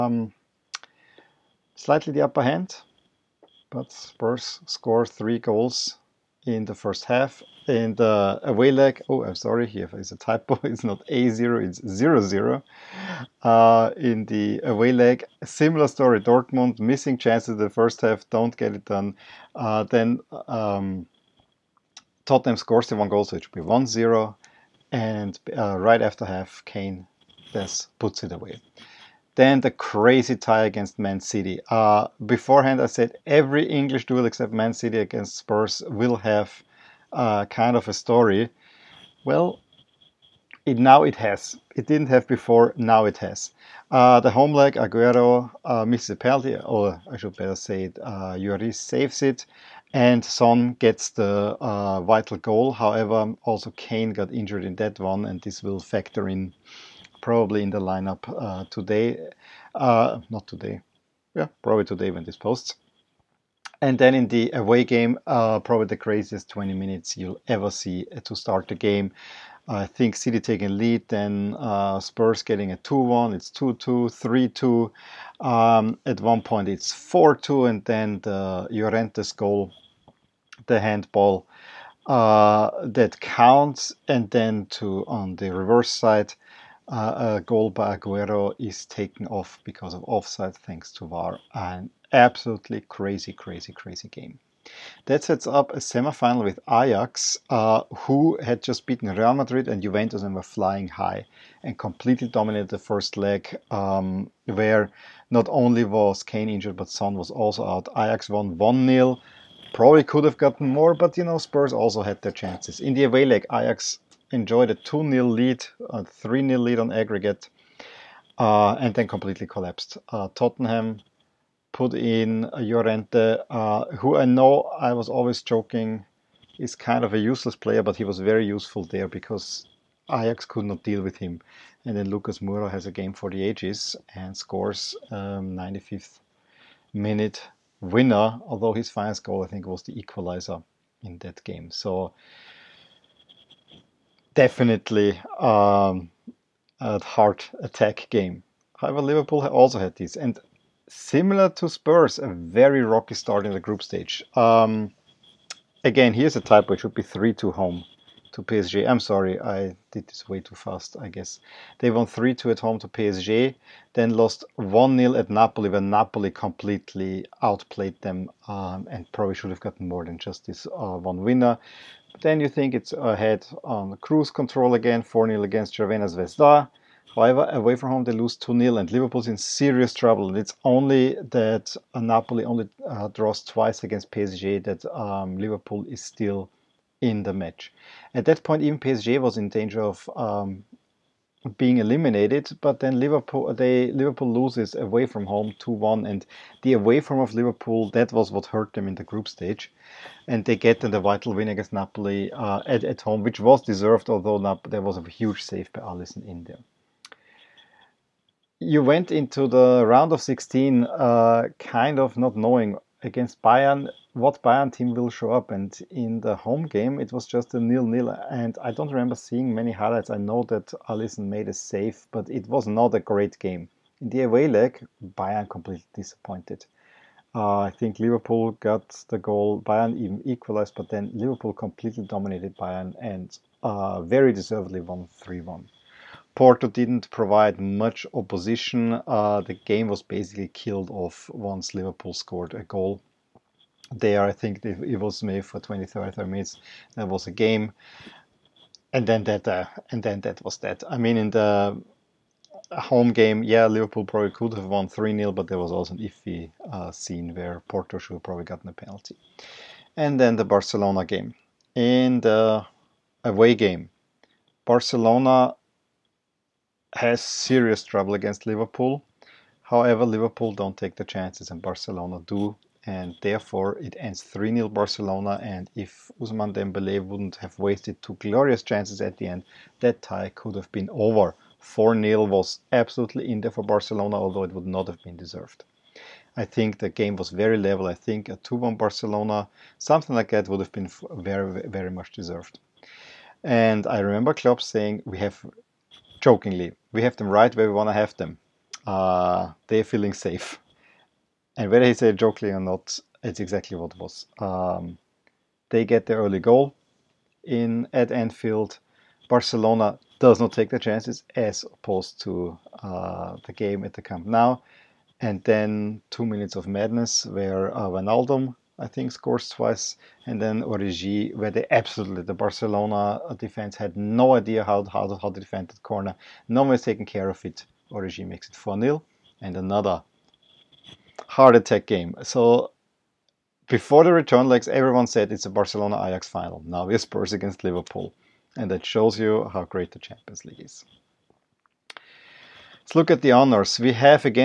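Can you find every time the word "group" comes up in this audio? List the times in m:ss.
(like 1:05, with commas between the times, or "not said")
2:33, 3:19.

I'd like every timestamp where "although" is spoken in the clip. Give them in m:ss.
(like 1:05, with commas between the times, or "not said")
2:18, 3:24, 4:44.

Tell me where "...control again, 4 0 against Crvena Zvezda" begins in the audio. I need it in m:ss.
2:54.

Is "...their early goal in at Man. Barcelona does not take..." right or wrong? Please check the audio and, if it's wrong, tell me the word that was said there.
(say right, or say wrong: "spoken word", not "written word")
wrong: "Anfield", not "Man".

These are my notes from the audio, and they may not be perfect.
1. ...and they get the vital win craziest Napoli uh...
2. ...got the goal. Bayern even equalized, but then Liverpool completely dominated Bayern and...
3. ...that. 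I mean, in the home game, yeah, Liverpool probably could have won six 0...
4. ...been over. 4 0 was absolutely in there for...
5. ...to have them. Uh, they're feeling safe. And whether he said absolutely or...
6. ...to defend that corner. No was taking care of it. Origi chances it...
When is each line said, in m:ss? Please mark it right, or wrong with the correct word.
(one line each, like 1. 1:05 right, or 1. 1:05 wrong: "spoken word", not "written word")
1. 3:20 wrong: "against", not "craziest"
2. 3:48 right
3. 4:10 wrong: "three", not "six"
4. 4:40 right
5. 4:57 wrong: "jokingly", not "absolutely"
6. 5:25 wrong: "makes", not "chances".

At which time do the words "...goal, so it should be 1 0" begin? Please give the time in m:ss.
0:23.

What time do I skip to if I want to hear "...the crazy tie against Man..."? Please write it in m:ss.
0:29.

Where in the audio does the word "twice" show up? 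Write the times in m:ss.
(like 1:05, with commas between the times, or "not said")
3:03, 5:19.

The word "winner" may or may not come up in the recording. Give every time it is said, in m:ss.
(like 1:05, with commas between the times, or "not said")
2:17, 2:51.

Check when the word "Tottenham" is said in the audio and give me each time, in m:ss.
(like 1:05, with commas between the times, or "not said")
0:22, 2:00.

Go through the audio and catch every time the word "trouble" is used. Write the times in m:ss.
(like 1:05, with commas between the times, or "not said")
2:59, 4:27.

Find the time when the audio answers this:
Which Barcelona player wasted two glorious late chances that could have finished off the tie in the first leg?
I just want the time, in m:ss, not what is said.
4:36.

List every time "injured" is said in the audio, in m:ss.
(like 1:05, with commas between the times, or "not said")
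0:54, 1:46.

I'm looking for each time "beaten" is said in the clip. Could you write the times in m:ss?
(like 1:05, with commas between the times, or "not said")
1:38.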